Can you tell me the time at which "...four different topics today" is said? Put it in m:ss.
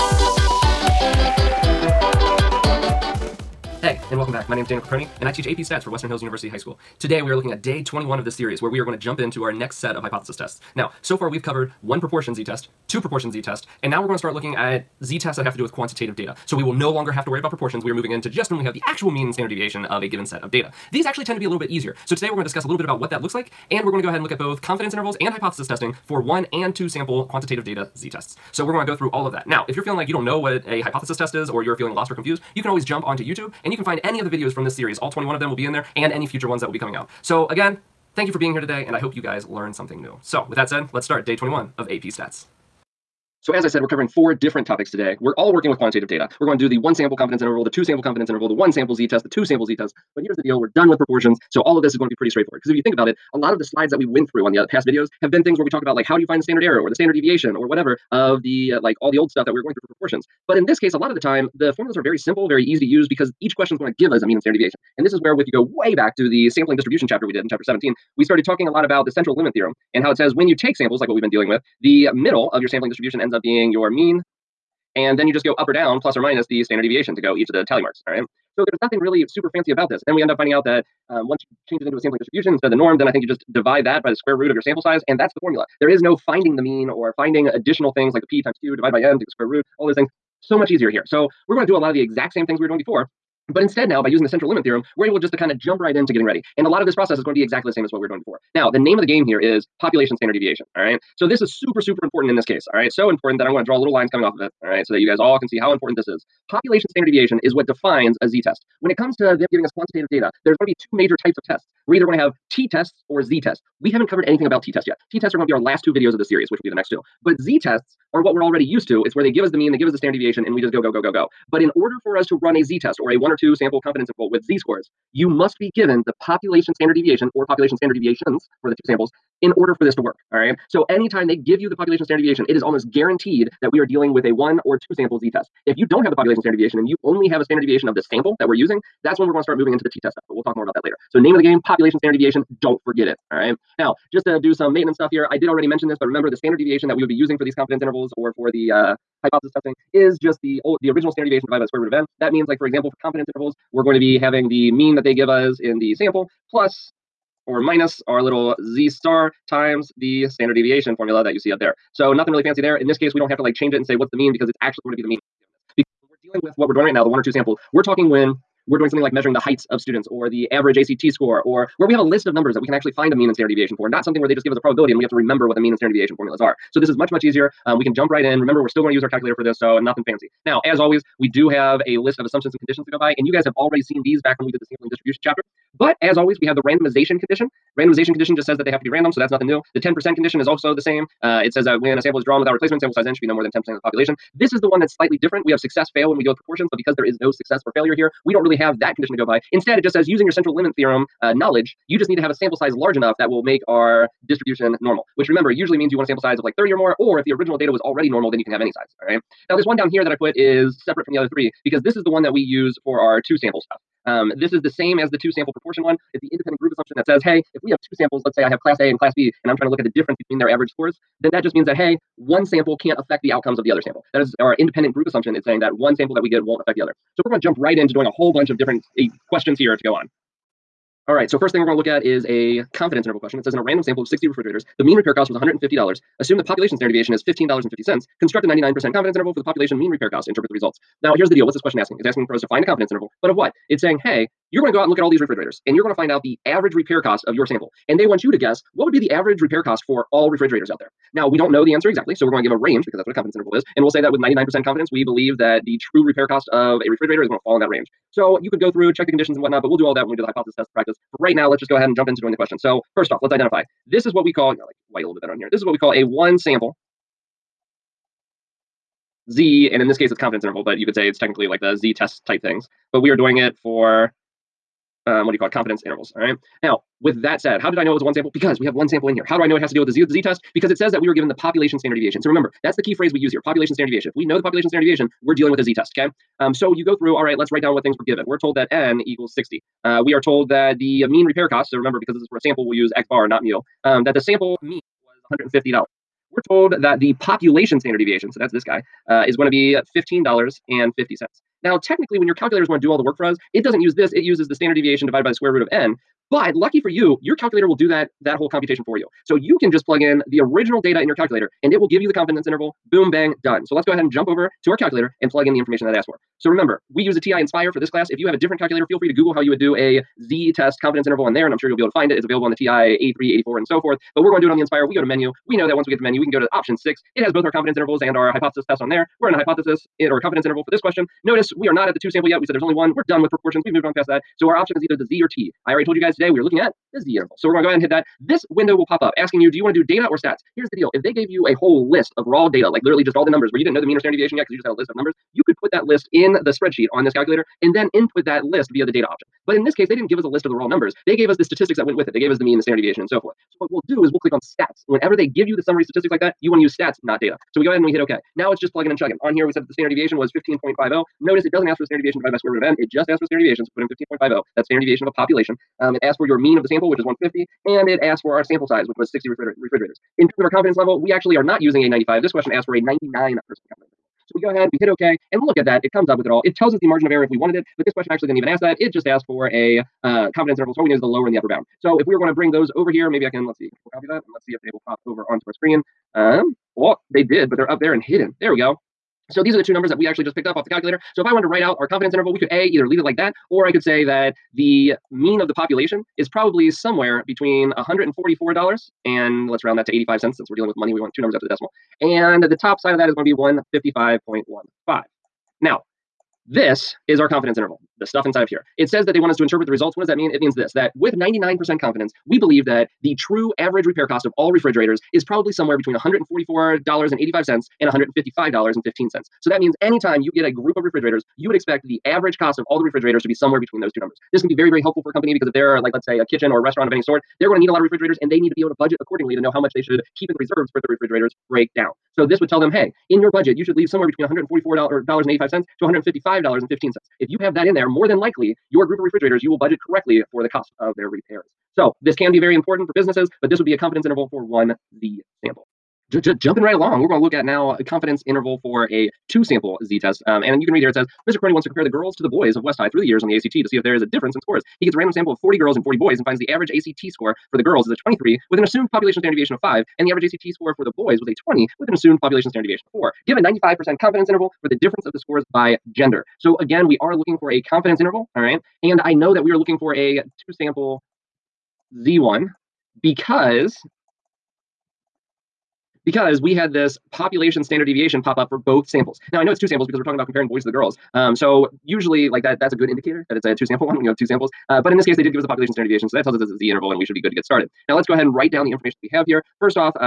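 0:44.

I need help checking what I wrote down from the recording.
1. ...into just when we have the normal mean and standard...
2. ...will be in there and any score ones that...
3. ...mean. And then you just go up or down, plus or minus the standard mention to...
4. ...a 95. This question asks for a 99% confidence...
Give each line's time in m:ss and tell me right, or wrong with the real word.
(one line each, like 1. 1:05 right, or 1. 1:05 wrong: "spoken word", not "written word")
1. 0:18 wrong: "actual", not "normal"
2. 0:35 wrong: "future", not "score"
3. 1:13 wrong: "deviation", not "mention"
4. 6:11 right.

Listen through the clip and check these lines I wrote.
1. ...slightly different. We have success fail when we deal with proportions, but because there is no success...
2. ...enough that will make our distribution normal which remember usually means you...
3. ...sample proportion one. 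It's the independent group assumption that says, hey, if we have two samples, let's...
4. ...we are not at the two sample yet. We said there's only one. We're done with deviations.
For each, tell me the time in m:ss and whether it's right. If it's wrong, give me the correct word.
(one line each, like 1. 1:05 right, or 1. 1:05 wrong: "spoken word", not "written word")
1. 3:14 right
2. 3:22 right
3. 3:35 right
4. 5:31 wrong: "proportions", not "deviations".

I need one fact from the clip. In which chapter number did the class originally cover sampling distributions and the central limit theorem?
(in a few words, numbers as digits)
17.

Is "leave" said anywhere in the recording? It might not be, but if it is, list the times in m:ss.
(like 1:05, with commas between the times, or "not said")
6:32, 7:13.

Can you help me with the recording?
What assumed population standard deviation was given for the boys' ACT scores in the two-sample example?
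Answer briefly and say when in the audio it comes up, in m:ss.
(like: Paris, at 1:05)
4, at 7:42.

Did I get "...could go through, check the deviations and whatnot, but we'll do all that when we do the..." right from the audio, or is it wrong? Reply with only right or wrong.
wrong.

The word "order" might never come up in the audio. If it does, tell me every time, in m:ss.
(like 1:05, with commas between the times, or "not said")
2:01, 2:09.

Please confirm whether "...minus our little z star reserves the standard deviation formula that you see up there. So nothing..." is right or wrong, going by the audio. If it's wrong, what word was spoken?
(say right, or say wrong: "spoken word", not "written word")
wrong: "times", not "reserves".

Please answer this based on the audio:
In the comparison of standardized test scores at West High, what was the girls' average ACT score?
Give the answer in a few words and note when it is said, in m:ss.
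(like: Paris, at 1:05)
23, at 7:37.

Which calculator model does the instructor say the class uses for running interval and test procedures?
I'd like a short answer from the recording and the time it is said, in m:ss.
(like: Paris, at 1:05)
TI-Nspire, at 5:17.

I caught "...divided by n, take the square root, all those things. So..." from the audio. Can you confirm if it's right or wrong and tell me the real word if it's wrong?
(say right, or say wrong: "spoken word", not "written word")
right.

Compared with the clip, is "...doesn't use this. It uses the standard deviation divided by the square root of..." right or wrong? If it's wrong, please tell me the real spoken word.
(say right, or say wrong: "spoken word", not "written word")
right.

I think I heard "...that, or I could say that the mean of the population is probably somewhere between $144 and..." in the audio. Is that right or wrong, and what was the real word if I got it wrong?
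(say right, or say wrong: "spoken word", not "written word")
right.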